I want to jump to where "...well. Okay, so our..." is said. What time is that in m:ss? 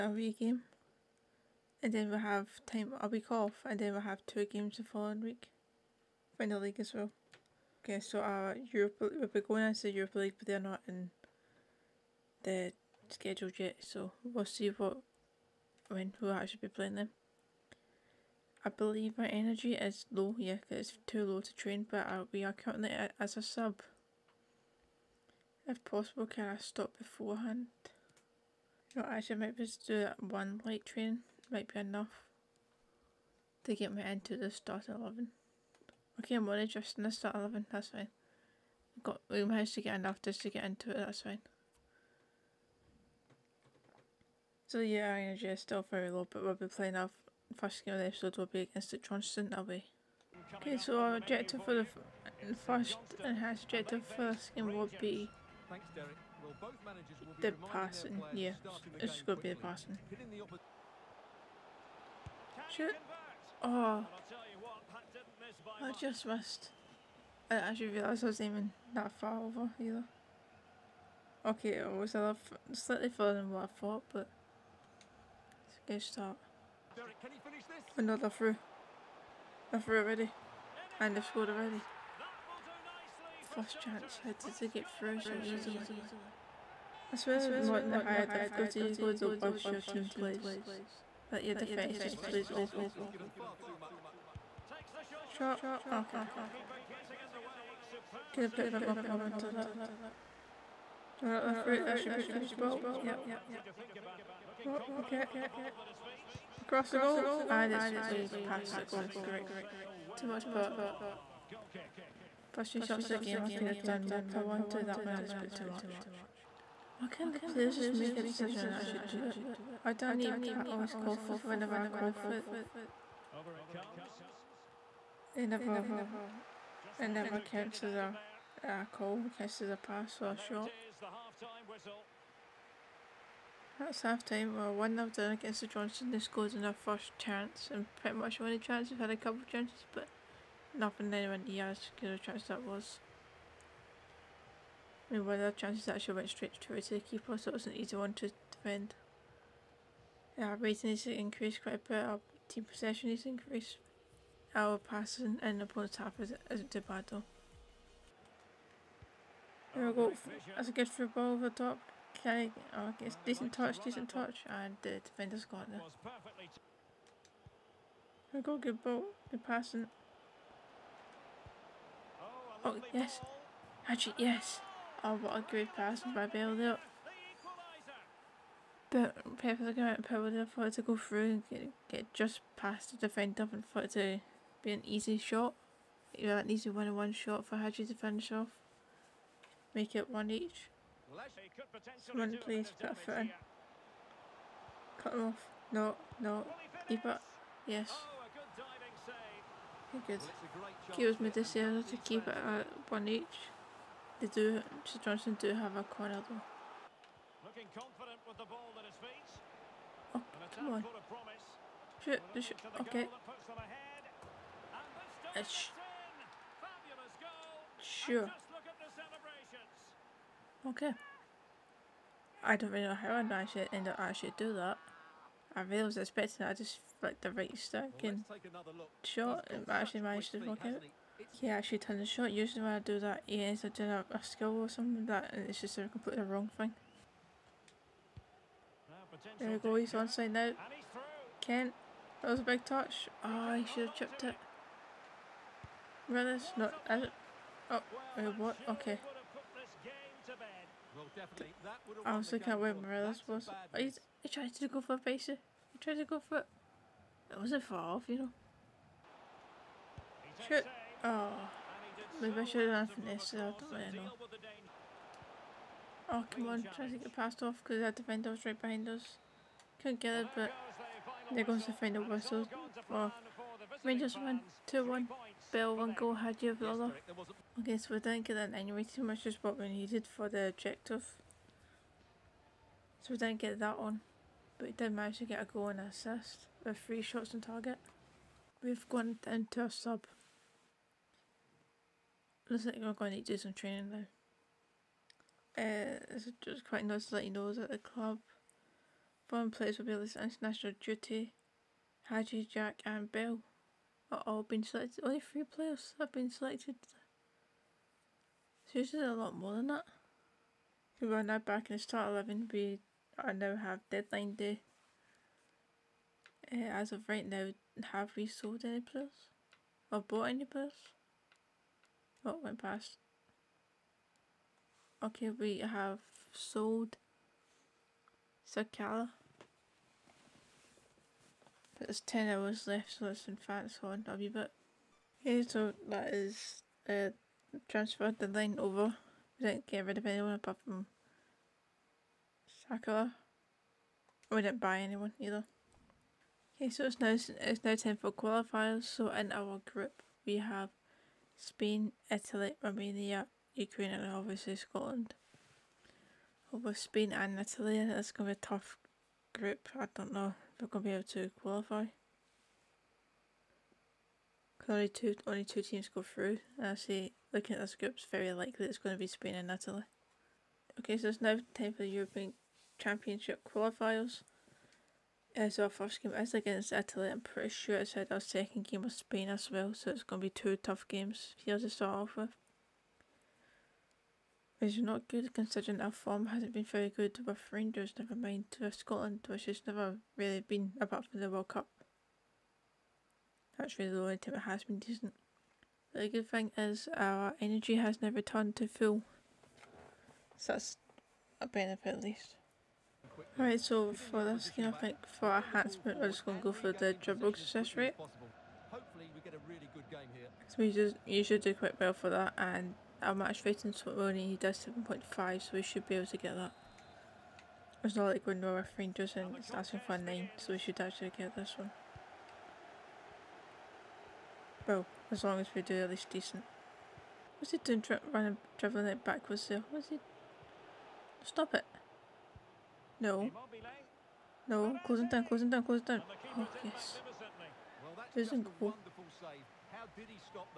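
0:06.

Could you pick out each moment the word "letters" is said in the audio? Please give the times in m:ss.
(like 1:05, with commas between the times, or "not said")
not said.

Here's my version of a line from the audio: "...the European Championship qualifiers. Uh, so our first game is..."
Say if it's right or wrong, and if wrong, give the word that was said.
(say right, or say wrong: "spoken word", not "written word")
right.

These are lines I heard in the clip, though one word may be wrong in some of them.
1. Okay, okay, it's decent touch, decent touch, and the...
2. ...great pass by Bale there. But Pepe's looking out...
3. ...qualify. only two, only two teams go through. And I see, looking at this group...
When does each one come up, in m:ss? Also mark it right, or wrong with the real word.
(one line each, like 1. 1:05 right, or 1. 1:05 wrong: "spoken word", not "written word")
1. 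2:42 right
2. 2:55 right
3. 6:01 right.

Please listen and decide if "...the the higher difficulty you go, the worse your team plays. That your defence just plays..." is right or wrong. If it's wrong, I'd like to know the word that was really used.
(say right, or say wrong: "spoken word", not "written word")
right.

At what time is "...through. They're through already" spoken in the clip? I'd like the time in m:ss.
1:18.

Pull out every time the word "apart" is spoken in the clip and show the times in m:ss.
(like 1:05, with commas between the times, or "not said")
5:40, 6:30.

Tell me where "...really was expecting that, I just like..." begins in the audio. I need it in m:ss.
3:45.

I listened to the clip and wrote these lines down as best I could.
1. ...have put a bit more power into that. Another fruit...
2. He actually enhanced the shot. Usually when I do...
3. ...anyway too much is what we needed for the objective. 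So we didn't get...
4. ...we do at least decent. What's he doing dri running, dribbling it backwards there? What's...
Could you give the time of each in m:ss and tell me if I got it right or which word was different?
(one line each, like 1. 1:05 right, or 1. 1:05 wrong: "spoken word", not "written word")
1. 1:38 right
2. 3:51 wrong: "turned", not "enhanced"
3. 4:38 right
4. 7:05 right.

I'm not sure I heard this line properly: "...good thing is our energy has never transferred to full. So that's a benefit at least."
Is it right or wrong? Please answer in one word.
wrong.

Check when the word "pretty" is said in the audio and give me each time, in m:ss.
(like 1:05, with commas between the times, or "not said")
2:17, 6:17.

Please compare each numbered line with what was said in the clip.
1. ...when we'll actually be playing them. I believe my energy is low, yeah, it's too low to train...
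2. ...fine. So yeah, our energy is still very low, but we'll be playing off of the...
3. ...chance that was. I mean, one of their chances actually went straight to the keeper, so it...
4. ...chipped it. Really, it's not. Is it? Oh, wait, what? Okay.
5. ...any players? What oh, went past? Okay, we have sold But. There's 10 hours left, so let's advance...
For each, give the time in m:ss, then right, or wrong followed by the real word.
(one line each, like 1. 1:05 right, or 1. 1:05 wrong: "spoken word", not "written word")
1. 0:15 right
2. 0:41 right
3. 2:22 right
4. 4:03 right
5. 5:20 wrong: "Sakala", not "But".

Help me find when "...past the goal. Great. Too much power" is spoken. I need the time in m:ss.
1:48.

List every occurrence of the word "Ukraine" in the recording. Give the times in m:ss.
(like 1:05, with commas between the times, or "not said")
5:53.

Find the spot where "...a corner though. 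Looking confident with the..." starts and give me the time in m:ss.
3:25.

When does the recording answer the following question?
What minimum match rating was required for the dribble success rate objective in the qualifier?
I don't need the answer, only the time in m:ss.
6:54.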